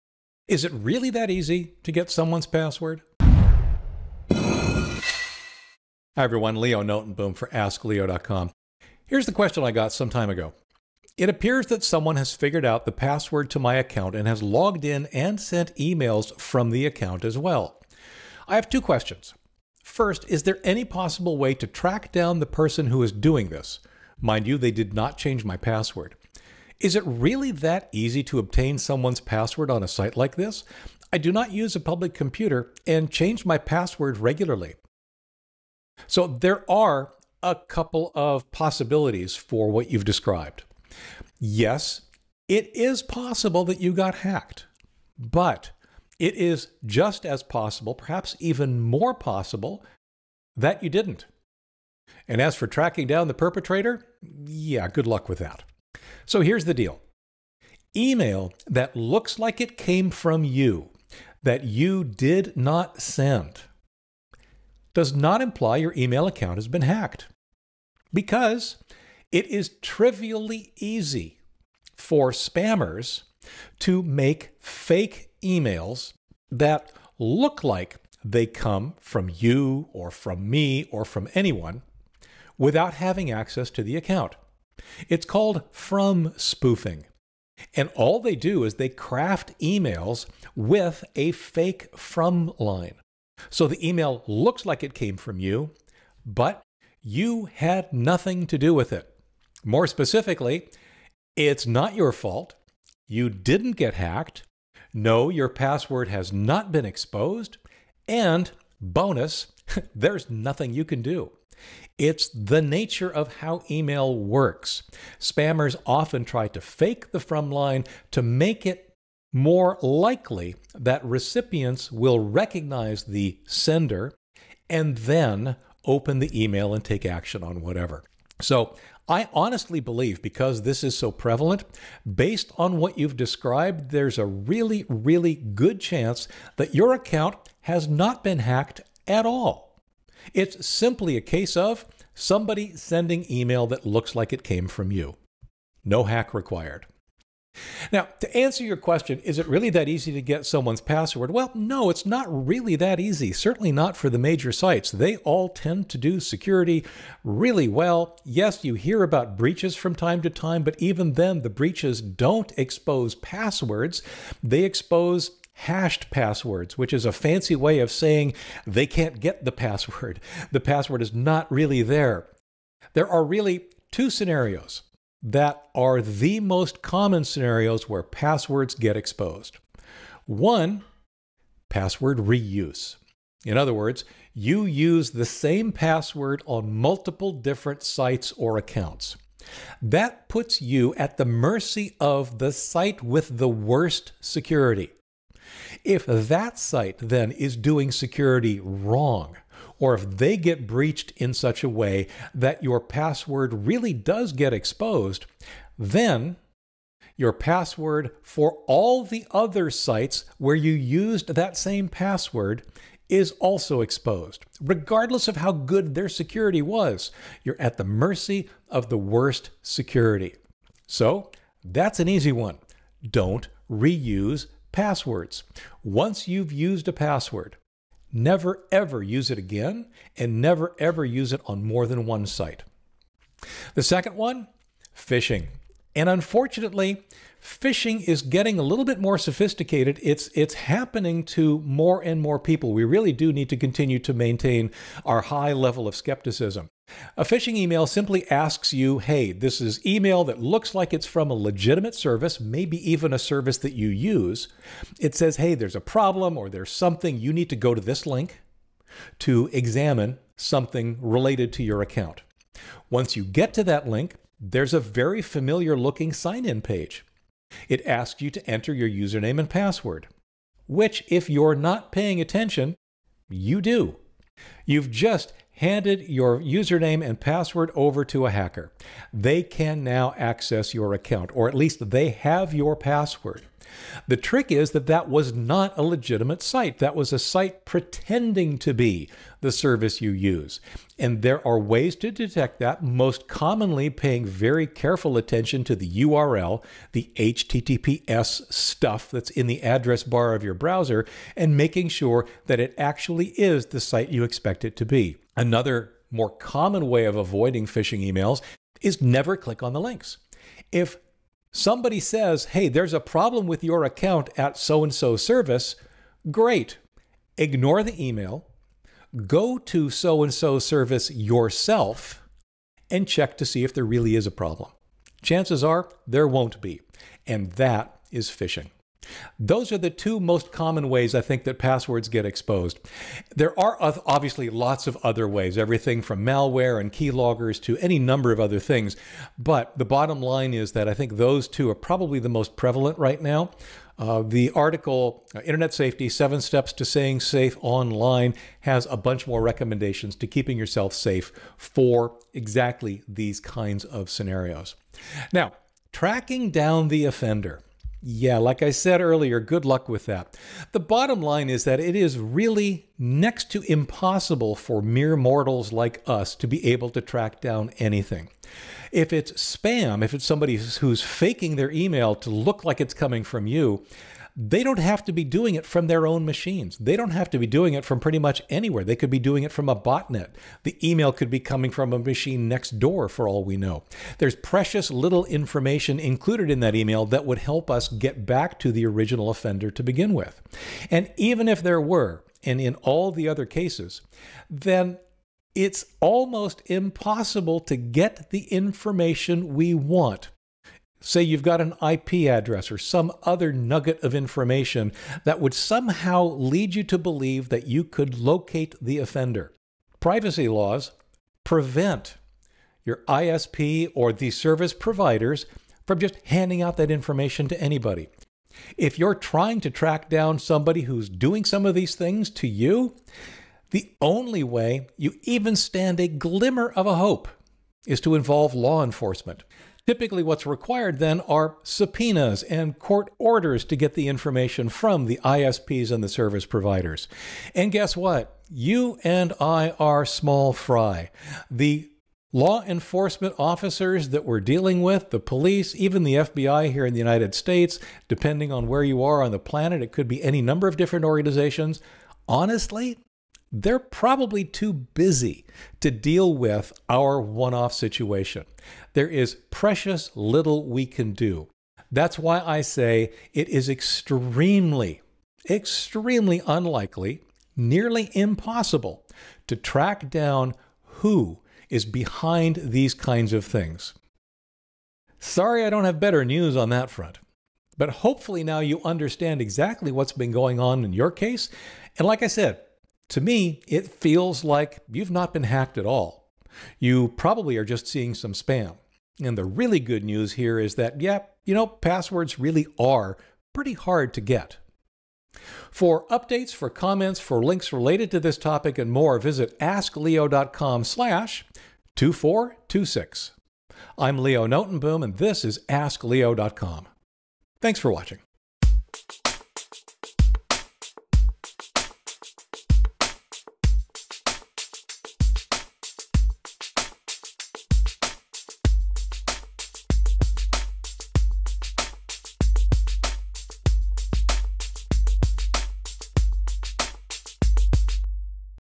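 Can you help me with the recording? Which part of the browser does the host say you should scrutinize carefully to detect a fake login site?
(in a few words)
the URL.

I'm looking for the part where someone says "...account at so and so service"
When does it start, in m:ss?
5:13.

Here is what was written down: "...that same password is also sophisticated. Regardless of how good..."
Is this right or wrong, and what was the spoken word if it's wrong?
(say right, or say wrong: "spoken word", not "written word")
wrong: "exposed", not "sophisticated".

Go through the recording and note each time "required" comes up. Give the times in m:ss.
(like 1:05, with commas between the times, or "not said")
2:26, 7:10.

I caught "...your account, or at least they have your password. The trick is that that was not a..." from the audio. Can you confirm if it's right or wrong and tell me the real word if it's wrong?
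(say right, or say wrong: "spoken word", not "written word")
right.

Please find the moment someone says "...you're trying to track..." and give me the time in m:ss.
6:58.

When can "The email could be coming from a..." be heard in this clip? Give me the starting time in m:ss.
6:20.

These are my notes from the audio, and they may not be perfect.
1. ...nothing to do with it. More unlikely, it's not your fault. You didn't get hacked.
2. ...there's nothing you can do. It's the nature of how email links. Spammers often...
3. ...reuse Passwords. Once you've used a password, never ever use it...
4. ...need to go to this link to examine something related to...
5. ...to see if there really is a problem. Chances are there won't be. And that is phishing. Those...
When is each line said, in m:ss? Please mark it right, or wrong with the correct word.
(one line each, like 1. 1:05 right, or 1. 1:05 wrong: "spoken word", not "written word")
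1. 1:37 wrong: "specifically", not "unlikely"
2. 1:49 wrong: "works", not "links"
3. 3:43 right
4. 4:17 right
5. 5:23 right.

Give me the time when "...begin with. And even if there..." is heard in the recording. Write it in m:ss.
6:29.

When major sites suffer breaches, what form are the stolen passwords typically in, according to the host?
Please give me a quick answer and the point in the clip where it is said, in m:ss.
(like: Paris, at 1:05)
hashed passwords, at 2:45.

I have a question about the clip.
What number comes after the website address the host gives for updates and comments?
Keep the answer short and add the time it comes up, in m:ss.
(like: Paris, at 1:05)
2426, at 8:21.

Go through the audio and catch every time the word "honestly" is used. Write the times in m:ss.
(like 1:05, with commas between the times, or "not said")
2:09, 7:32.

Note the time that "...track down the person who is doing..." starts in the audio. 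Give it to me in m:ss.
0:21.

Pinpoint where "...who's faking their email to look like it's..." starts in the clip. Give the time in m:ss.
6:10.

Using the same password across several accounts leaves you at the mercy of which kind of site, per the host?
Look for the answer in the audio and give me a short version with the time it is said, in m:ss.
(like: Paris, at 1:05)
the site with the worst security, at 3:12.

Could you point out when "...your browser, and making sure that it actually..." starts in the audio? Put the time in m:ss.
5:00.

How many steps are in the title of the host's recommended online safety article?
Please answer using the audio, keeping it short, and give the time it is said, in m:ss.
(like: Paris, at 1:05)
7, at 5:46.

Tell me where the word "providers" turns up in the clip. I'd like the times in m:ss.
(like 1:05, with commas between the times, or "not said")
6:54, 7:16.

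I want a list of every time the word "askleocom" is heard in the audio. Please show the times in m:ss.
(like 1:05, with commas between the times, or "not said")
0:07, 8:19, 8:25.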